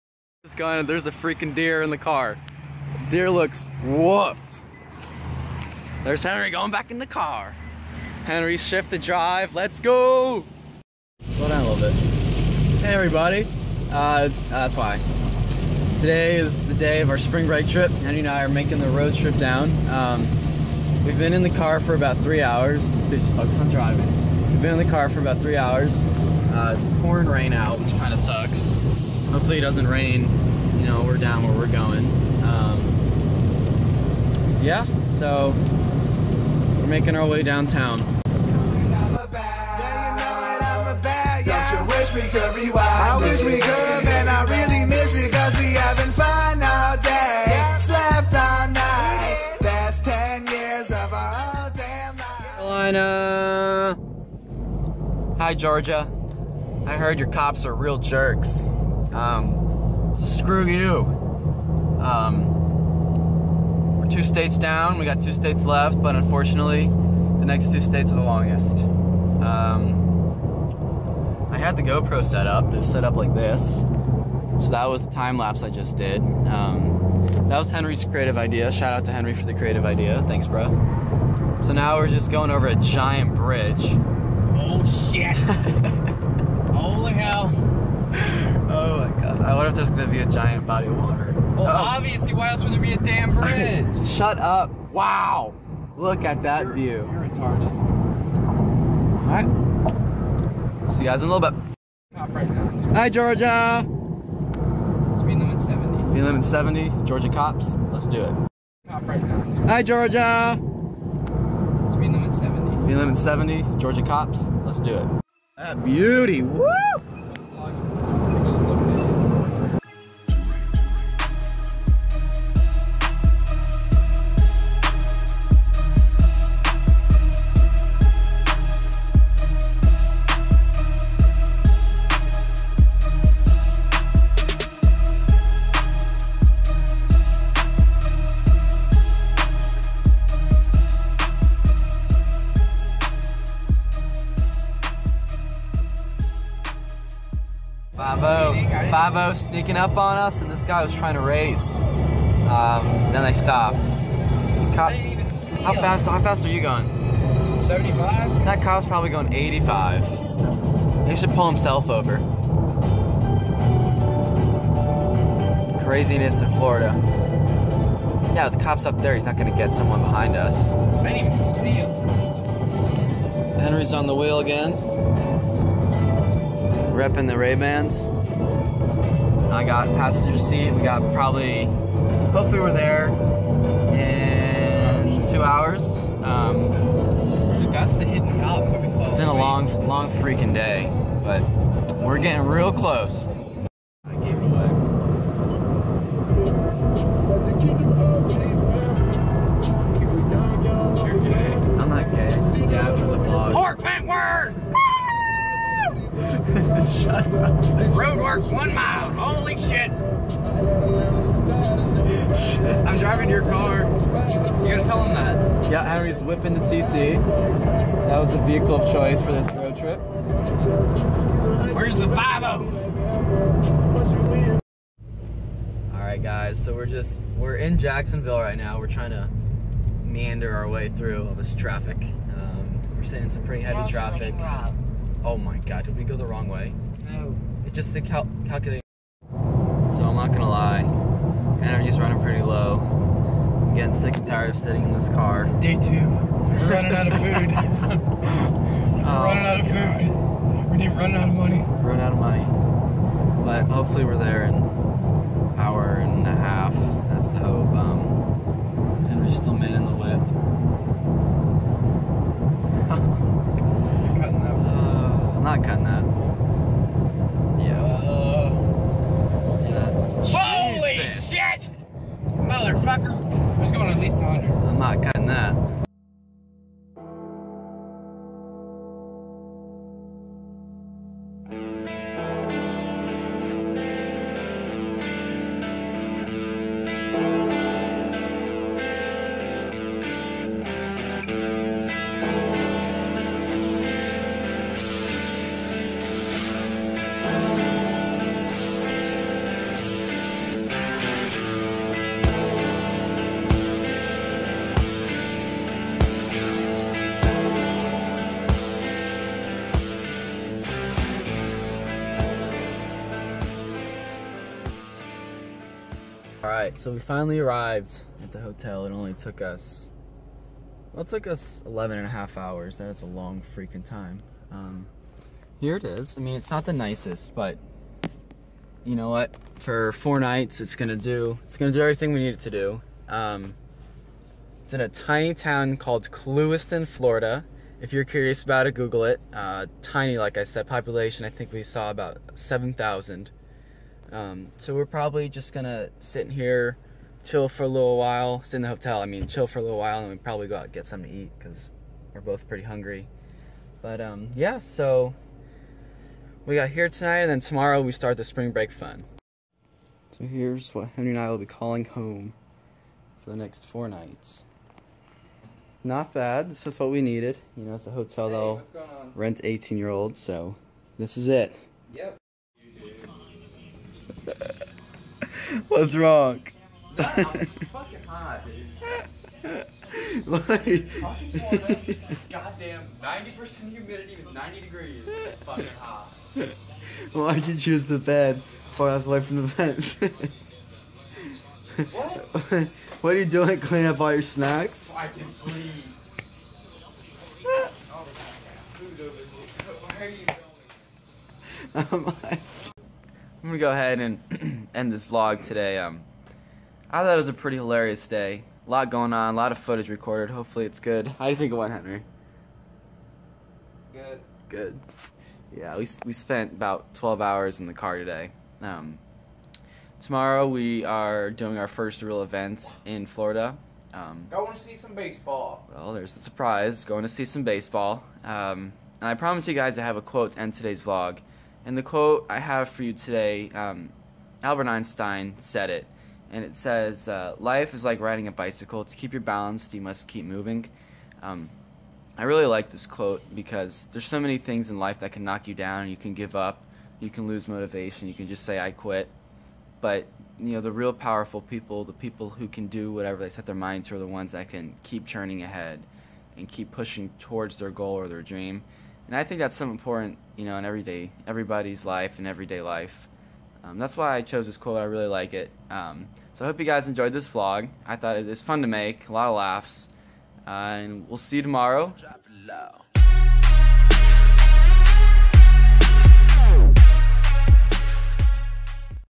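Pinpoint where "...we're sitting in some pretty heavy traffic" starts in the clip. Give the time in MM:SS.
03:52.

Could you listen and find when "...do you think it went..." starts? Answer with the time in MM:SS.
06:51.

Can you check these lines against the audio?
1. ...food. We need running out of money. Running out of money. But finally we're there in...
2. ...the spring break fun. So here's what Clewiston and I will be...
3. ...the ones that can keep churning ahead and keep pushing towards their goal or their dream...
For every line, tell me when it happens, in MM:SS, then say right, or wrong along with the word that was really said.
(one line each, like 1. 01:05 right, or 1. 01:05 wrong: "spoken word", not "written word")
1. 04:09 wrong: "hopefully", not "finally"
2. 05:58 wrong: "Henry", not "Clewiston"
3. 07:33 right.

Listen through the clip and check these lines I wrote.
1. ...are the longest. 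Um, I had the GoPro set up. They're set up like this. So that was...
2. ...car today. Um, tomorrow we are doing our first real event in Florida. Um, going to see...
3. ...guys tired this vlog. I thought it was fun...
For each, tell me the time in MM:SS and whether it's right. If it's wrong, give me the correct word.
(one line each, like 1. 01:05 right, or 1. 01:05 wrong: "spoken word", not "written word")
1. 01:08 right
2. 06:57 right
3. 07:46 wrong: "enjoyed", not "tired".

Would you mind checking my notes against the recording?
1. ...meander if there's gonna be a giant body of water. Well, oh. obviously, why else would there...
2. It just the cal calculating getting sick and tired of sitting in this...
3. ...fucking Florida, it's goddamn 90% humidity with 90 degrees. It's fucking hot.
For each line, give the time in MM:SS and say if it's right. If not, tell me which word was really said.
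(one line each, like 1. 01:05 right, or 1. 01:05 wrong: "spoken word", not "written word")
1. 01:29 wrong: "wonder", not "meander"
2. 03:57 right
3. 06:20 right.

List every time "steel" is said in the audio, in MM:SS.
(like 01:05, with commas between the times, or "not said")
not said.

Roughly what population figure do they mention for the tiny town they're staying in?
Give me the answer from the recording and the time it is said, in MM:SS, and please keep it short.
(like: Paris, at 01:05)
7,000, at 05:42.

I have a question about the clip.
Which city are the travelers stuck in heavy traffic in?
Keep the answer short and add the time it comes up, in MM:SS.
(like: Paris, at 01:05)
Jacksonville, at 03:47.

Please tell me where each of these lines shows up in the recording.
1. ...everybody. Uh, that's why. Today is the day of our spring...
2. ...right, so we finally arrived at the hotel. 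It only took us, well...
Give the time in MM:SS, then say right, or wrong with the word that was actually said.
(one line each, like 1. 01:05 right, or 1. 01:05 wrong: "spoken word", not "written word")
1. 00:12 right
2. 05:16 right.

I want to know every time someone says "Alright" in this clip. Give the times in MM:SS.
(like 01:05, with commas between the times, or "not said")
01:39, 03:45.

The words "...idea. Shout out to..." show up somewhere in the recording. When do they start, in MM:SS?
01:18.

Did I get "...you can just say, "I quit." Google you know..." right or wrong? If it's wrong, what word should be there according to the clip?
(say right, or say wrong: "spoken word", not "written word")
wrong: "But", not "Google".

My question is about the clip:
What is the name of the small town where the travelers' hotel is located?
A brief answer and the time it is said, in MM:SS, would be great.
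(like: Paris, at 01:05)
Clewiston, Florida, at 05:36.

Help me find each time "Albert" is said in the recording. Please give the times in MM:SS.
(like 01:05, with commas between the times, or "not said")
07:14.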